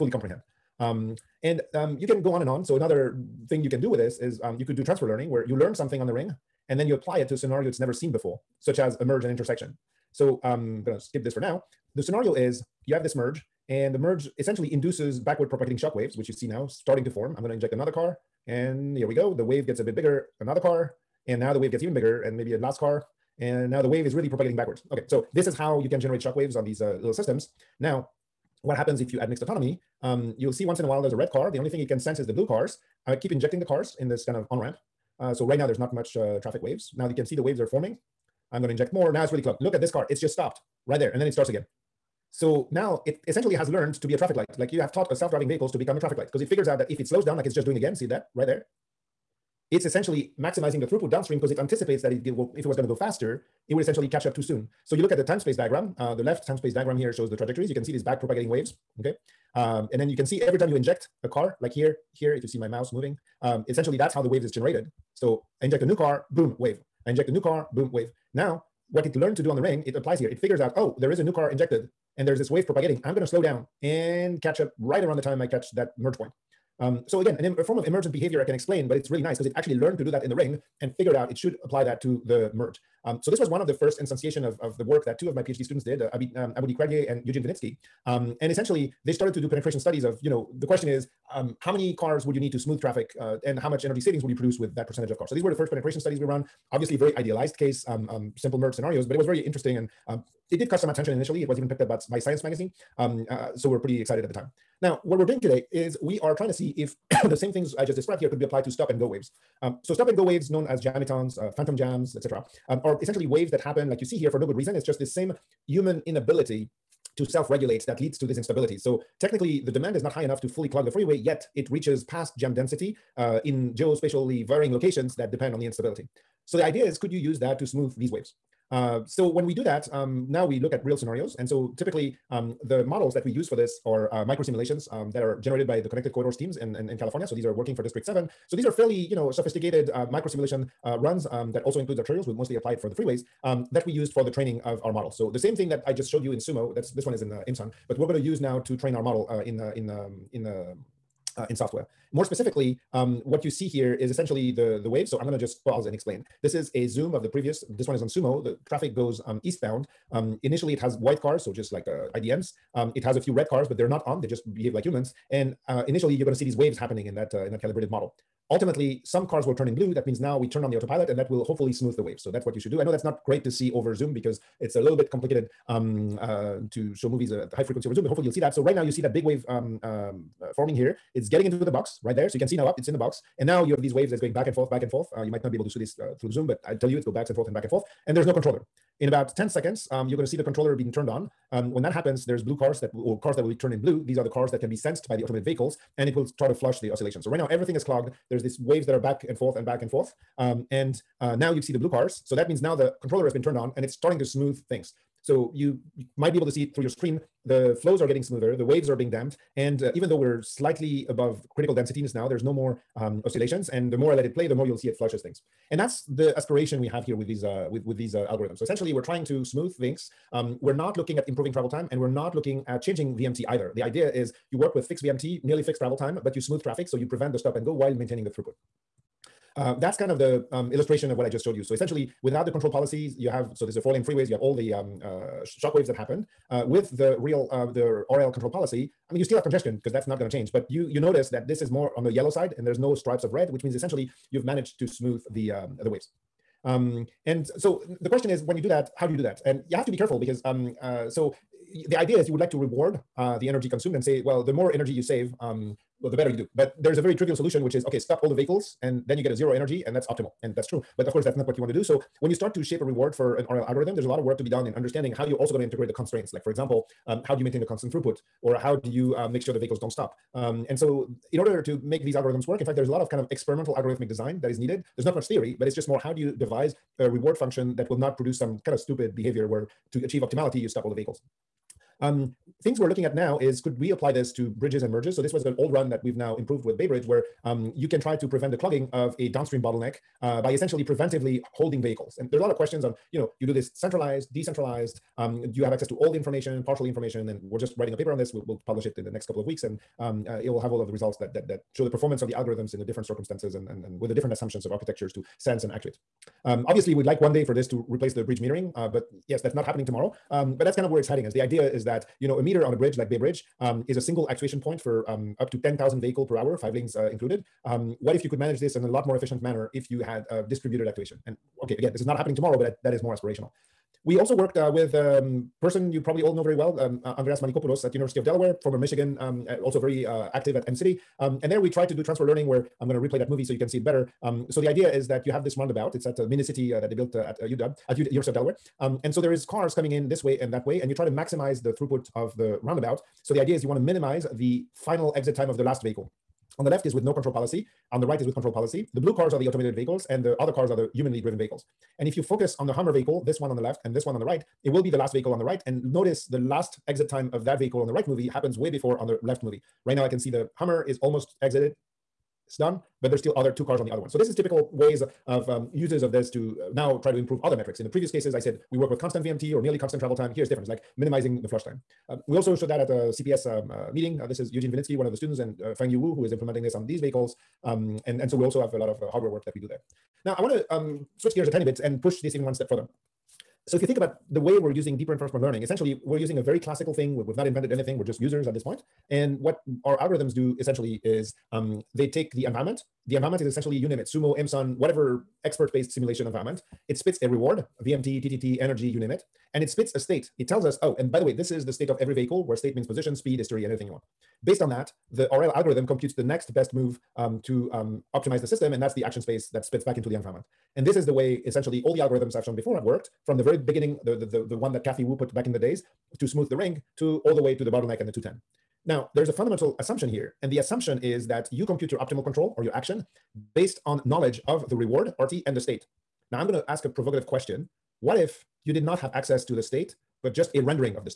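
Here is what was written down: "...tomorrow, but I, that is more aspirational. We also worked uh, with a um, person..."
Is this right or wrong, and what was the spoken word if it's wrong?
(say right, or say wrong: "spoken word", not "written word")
right.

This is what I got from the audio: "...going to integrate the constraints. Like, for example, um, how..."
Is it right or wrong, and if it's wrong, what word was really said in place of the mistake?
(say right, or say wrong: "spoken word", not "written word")
right.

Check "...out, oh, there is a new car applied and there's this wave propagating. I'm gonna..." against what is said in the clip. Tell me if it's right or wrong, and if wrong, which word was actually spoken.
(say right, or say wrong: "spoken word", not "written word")
wrong: "injected", not "applied".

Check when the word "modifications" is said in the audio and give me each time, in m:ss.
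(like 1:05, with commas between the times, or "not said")
not said.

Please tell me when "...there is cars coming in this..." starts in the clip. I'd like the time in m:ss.
5:39.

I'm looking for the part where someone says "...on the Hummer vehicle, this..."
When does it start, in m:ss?
5:52.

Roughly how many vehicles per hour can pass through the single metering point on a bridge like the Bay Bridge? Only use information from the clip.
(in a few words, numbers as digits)
10,000.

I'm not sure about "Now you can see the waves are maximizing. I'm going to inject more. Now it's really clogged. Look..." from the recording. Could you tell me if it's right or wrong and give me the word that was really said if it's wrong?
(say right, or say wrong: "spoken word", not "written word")
wrong: "forming", not "maximizing".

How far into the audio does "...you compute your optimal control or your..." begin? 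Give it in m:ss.
7:01.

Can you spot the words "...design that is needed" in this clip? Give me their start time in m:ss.
4:34.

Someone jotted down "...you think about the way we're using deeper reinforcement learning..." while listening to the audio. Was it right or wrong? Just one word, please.
right.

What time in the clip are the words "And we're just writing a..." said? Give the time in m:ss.
4:57.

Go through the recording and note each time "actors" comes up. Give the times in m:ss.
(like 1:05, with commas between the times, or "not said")
not said.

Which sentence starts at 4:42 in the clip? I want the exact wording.
Um, things we're looking at now is could we apply this to bridges and merges?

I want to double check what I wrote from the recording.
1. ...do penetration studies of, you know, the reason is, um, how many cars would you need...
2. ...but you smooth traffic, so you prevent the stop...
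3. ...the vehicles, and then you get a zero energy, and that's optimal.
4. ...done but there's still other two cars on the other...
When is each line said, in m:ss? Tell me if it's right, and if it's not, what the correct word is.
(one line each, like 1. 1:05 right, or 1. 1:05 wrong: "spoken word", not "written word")
1. 1:29 wrong: "question", not "reason"
2. 3:46 right
3. 4:18 right
4. 6:02 right.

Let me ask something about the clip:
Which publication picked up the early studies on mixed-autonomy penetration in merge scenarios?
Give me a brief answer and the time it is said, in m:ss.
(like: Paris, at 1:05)
Science magazine, at 1:42.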